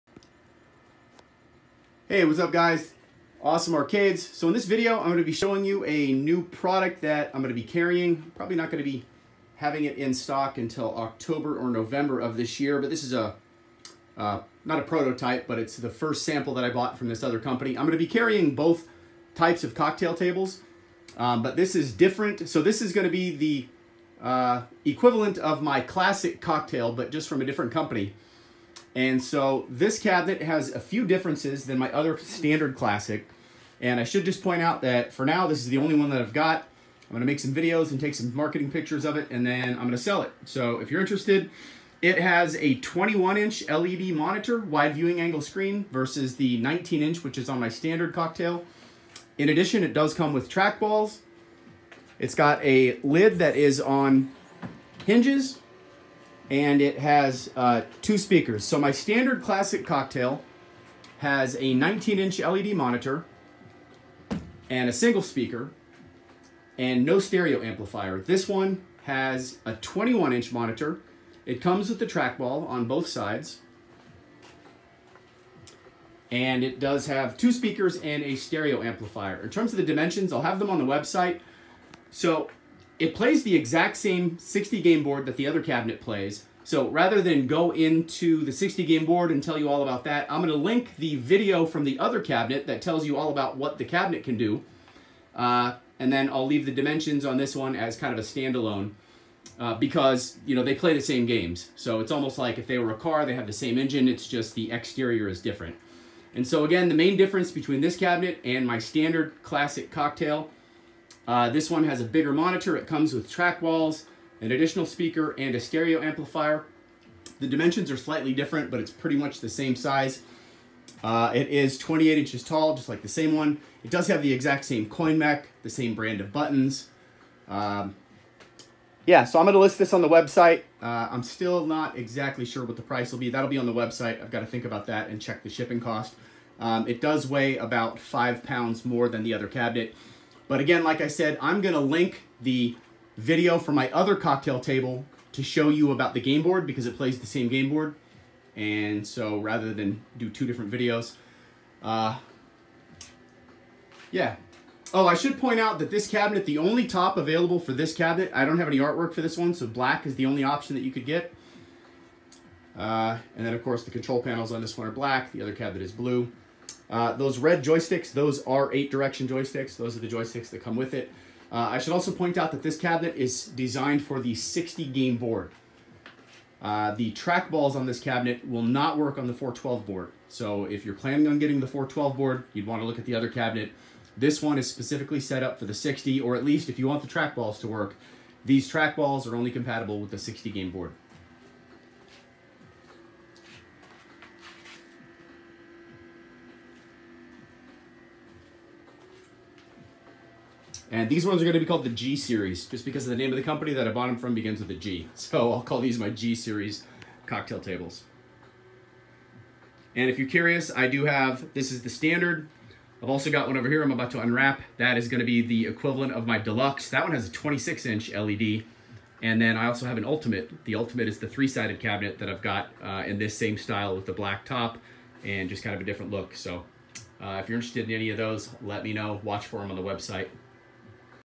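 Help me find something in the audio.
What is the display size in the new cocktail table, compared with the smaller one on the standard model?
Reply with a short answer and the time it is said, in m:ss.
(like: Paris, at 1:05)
21 inch, at 0:42.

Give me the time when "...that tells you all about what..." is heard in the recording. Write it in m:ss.
1:32.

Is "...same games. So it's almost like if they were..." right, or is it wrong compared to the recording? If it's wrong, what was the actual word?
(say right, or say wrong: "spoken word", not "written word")
right.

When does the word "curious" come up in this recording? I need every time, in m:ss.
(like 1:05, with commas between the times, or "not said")
3:30.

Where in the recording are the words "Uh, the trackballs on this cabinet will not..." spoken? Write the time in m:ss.
2:56.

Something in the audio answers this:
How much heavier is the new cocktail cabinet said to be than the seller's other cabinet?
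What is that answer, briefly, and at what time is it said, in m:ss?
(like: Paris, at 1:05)
5 pounds, at 2:17.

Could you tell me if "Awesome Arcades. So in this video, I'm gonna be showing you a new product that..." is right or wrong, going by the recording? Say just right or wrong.
right.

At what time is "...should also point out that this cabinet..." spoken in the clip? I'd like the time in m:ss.
2:51.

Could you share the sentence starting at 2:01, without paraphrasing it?
Uh, it is 28 inches tall, just like the same one.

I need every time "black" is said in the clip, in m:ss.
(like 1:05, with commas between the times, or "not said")
2:39, 2:44, 3:44.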